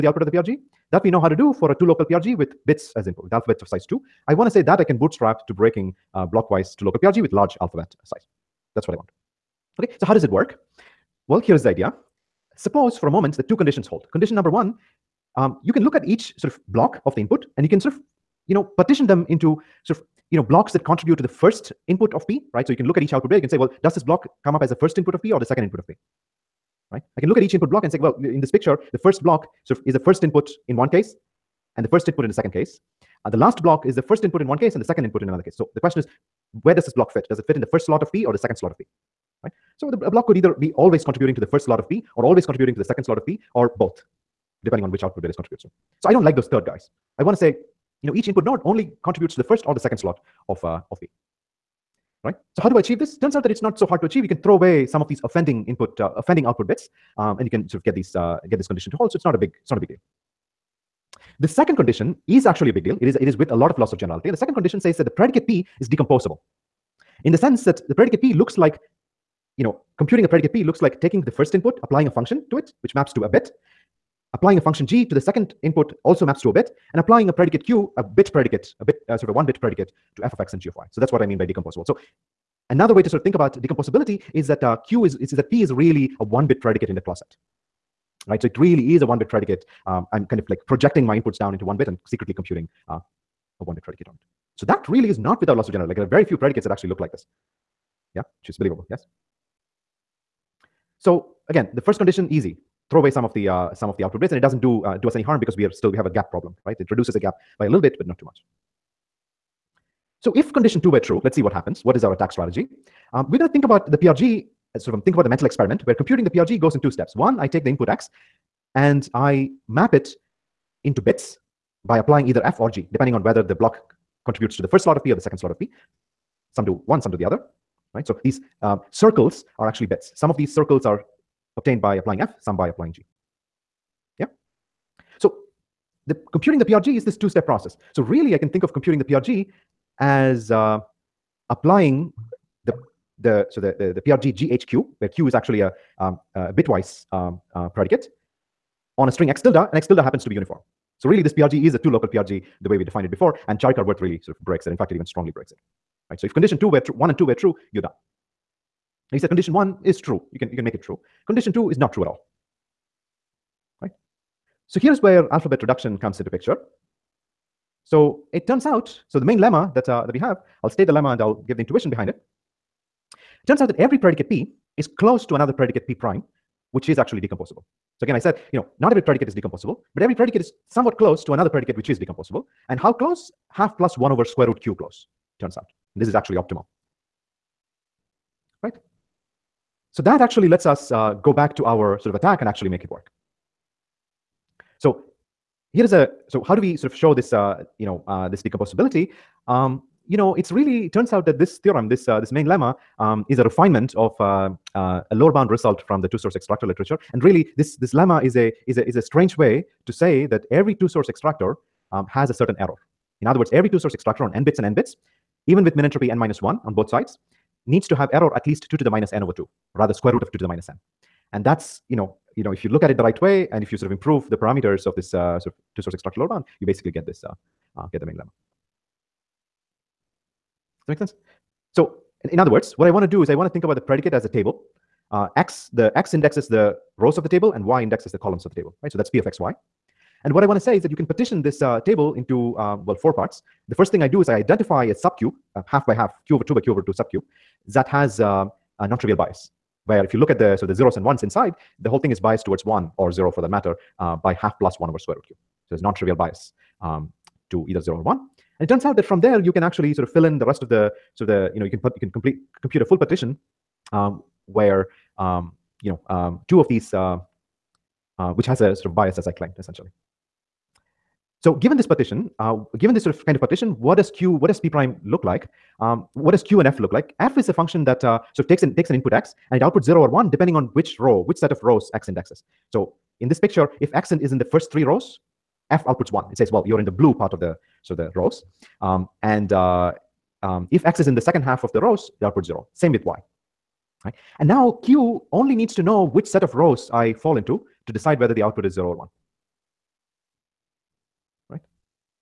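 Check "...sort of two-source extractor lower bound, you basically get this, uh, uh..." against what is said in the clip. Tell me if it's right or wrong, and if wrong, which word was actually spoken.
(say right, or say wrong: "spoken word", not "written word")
right.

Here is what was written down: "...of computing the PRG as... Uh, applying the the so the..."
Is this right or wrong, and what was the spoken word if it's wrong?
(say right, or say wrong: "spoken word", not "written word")
right.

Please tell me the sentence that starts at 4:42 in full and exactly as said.
So in this picture, if X is in the first three rows, F outputs one.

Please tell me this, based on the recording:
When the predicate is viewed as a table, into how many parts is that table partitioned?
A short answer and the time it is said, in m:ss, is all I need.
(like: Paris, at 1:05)
4, at 4:02.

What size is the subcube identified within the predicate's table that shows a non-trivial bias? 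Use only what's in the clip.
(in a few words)
q/2 by q/2.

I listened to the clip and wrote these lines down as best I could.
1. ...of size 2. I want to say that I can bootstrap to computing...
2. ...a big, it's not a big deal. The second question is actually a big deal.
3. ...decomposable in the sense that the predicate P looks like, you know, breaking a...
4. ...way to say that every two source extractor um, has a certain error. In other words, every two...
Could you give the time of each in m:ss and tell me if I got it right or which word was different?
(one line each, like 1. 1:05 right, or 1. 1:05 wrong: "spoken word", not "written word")
1. 0:03 wrong: "breaking", not "computing"
2. 0:59 wrong: "condition", not "question"
3. 1:05 wrong: "computing", not "breaking"
4. 3:29 right.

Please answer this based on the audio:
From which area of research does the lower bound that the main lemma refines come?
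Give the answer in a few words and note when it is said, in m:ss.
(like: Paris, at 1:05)
two source extractor literature, at 3:26.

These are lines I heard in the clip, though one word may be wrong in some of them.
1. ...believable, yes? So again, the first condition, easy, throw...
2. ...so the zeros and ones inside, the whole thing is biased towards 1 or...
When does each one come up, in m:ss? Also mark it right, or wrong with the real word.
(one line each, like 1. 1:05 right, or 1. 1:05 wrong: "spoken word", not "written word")
1. 1:38 right
2. 4:10 right.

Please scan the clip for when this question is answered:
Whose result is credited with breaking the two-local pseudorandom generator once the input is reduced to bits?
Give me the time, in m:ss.
2:33.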